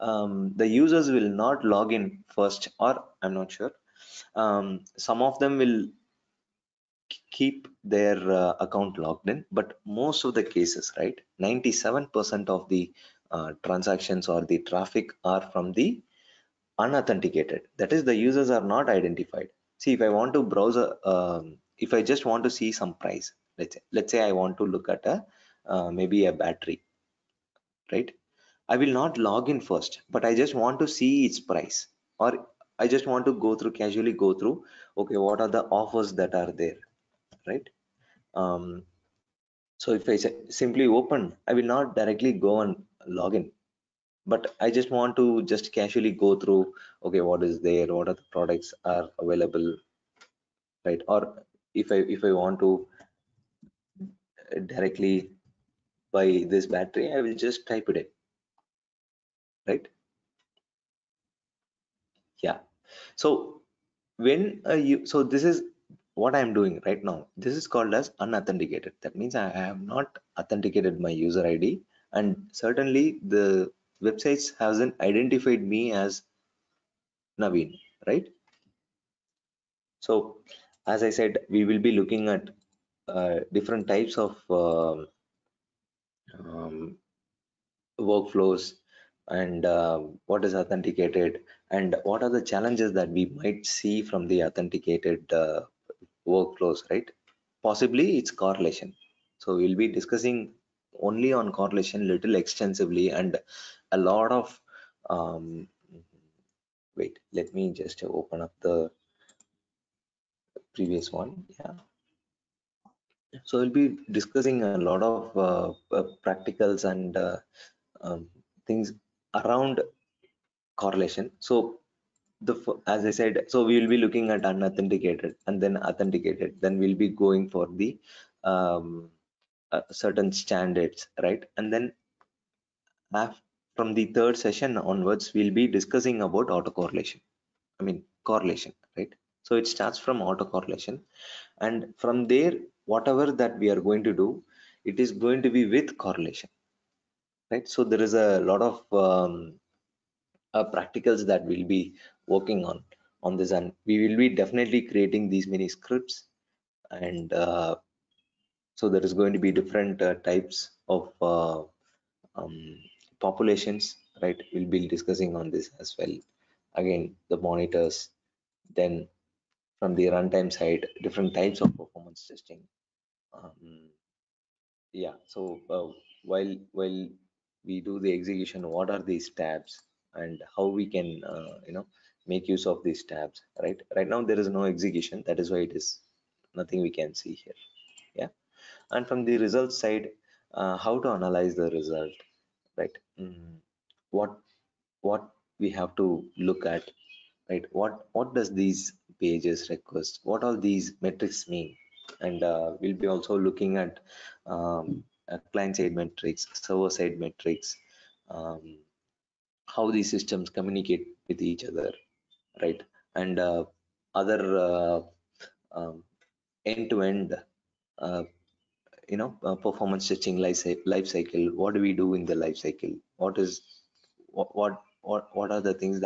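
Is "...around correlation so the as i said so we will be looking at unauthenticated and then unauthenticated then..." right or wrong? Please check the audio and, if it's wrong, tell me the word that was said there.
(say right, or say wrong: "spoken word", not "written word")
wrong: "authenticated", not "unauthenticated".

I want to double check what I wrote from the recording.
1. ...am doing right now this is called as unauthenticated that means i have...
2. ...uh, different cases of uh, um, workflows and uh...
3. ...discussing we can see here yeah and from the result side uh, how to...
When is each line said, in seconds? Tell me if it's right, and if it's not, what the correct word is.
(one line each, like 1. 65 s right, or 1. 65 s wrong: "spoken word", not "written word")
1. 66 s right
2. 83 s wrong: "types", not "cases"
3. 186 s wrong: "nothing", not "discussing".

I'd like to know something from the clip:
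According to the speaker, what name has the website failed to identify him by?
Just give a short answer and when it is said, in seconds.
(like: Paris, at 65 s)
Naveen, at 77 s.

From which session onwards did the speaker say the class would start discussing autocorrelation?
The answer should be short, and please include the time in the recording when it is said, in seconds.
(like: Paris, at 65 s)
third session, at 134 s.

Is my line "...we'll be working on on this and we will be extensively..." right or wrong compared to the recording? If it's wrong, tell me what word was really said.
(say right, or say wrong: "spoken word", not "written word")
wrong: "definitely", not "extensively".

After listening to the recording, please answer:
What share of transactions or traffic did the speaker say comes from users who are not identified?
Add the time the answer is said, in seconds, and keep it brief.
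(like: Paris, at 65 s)
97%, at 11 s.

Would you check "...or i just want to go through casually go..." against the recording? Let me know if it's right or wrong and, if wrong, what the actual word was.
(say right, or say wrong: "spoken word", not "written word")
right.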